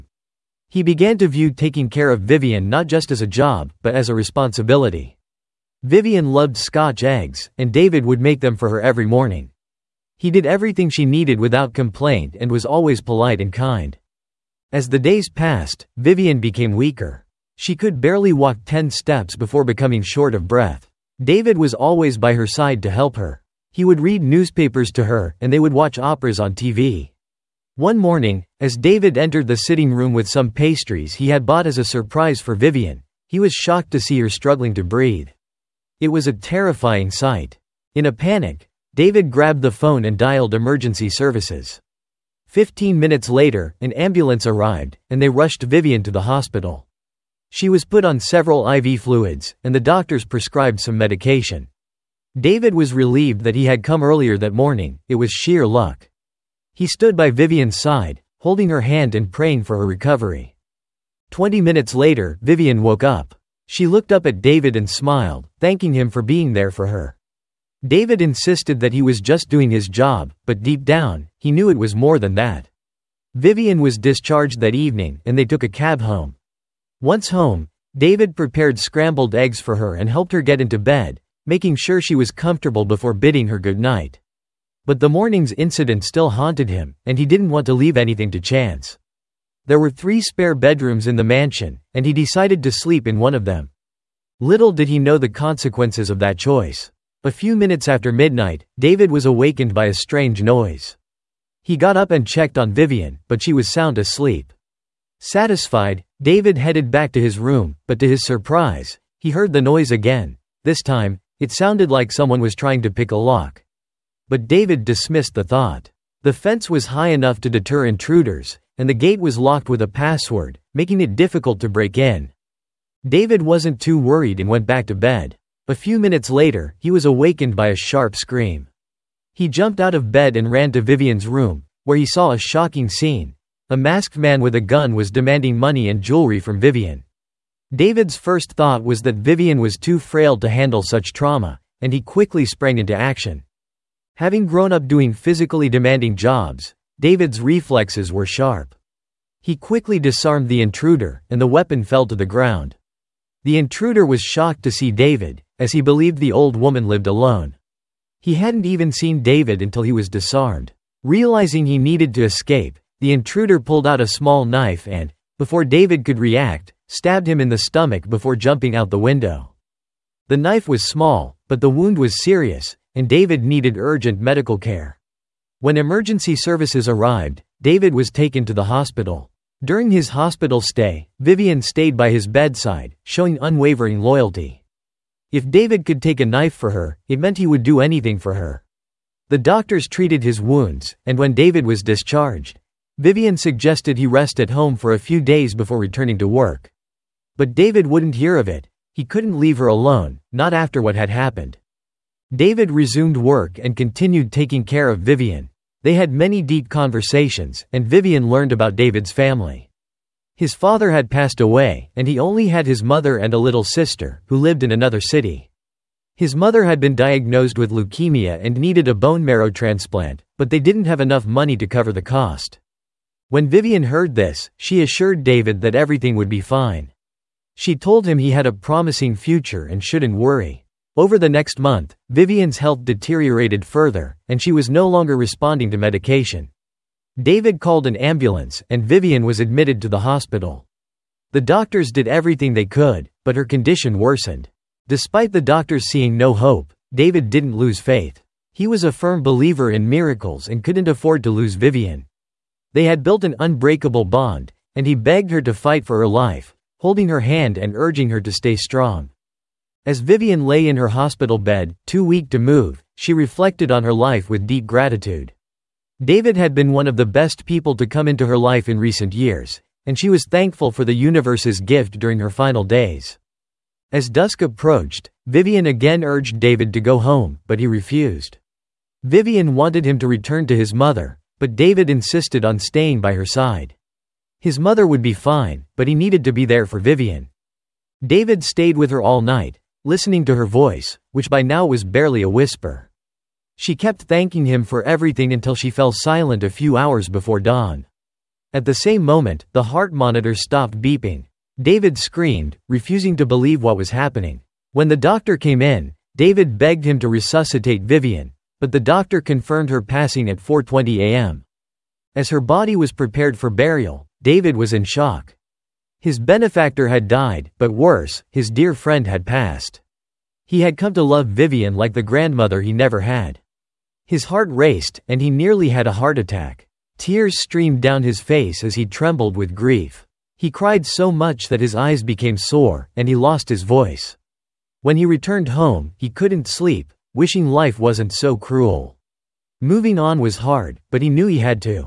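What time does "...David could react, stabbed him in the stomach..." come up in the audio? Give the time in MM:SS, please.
02:45.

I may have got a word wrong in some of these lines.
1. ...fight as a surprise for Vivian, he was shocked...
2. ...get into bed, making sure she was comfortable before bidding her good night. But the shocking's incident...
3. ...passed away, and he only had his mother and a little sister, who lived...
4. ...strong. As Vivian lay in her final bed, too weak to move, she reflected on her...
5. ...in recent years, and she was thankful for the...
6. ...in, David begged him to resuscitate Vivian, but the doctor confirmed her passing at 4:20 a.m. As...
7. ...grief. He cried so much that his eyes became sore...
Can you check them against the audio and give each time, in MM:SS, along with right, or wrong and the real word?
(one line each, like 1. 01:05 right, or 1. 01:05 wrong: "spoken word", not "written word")
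1. 00:31 wrong: "bought", not "fight"
2. 01:20 wrong: "morning", not "shocking"
3. 03:31 right
4. 04:18 wrong: "hospital", not "final"
5. 04:28 right
6. 05:05 right
7. 05:29 right.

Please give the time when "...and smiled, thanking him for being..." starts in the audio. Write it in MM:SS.
01:04.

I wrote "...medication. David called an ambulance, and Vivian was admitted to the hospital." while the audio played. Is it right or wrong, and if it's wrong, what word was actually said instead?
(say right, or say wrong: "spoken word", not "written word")
right.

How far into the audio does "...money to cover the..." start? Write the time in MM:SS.
03:41.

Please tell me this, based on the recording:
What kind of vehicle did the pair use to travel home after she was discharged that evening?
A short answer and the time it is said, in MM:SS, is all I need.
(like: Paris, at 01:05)
cab, at 01:15.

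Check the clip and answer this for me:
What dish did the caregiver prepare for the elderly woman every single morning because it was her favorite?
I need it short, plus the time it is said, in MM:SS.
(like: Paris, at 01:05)
scotch eggs, at 00:06.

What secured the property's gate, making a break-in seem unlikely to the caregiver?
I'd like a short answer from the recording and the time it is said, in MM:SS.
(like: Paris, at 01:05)
password, at 01:59.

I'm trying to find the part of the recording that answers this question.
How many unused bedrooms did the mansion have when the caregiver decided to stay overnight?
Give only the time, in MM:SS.
01:29.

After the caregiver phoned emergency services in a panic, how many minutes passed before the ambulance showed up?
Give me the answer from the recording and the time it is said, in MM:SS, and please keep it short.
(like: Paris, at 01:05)
15, at 00:42.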